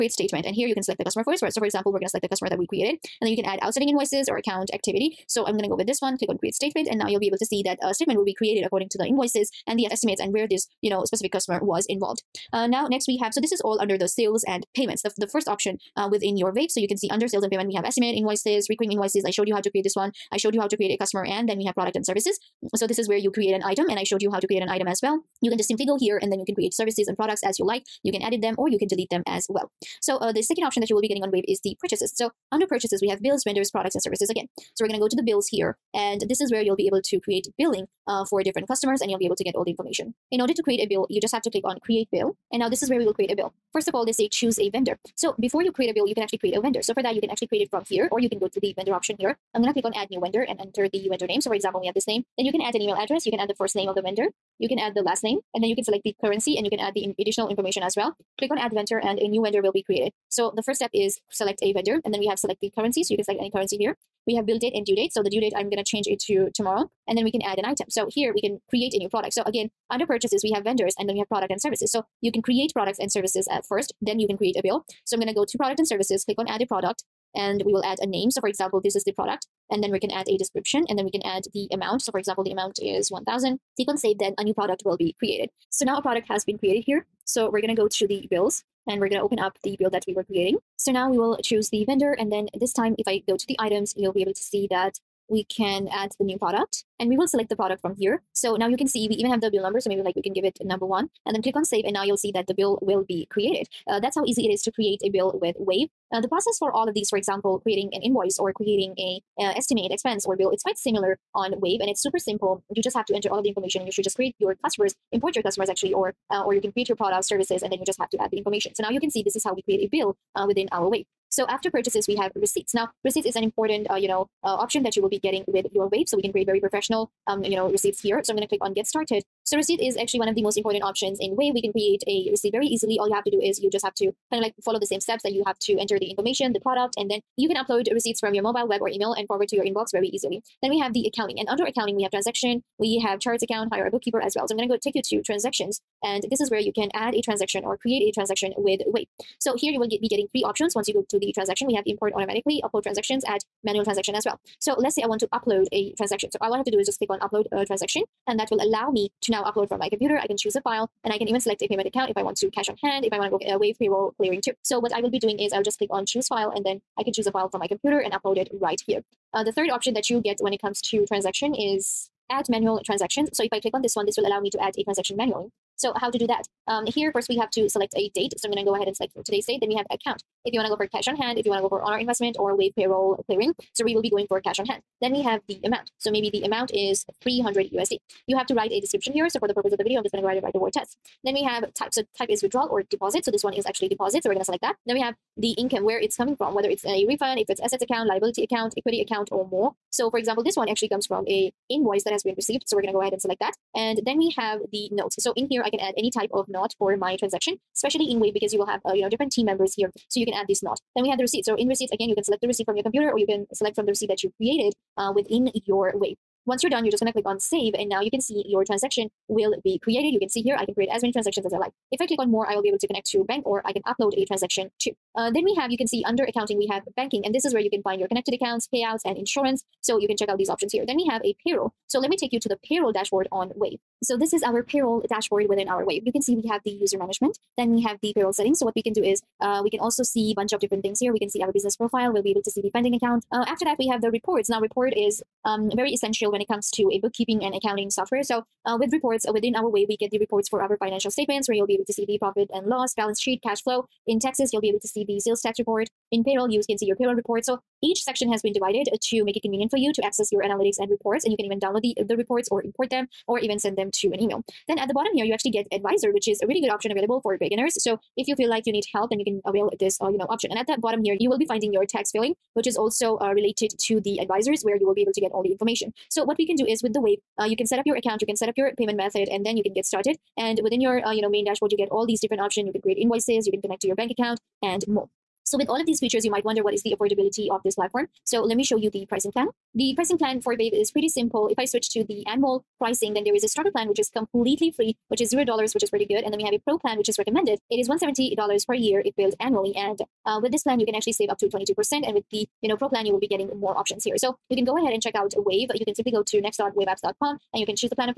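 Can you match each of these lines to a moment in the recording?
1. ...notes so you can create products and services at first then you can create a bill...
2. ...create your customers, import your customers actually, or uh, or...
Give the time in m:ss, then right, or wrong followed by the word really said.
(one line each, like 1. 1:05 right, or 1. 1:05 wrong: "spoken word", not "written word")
1. 1:11 wrong: "services", not "notes"
2. 1:54 right.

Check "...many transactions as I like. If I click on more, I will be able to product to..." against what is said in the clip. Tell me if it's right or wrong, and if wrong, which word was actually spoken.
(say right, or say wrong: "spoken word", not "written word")
wrong: "connect", not "product".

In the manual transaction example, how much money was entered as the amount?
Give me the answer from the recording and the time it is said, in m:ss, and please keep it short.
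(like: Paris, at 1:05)
300 USD, at 3:07.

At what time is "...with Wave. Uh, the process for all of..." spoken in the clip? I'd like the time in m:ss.
1:45.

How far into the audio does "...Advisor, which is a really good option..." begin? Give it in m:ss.
4:25.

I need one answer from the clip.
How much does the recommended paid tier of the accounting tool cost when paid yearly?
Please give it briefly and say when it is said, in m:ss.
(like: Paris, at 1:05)
$170 per year, at 4:57.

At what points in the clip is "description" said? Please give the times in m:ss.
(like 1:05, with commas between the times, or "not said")
1:20, 3:08.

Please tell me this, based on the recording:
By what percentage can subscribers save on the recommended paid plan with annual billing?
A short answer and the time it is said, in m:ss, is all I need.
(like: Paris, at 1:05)
22%, at 5:01.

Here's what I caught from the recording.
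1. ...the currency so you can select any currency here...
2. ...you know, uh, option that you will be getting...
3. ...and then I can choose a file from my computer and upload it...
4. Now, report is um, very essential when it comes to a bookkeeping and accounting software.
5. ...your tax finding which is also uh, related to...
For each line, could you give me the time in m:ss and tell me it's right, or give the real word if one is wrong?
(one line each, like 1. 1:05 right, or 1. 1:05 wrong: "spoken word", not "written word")
1. 1:02 right
2. 2:03 right
3. 2:46 right
4. 4:04 right
5. 4:31 wrong: "filling", not "finding".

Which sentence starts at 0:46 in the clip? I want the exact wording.
So for that, you can actually create it from here, or you can go to the vendor option here.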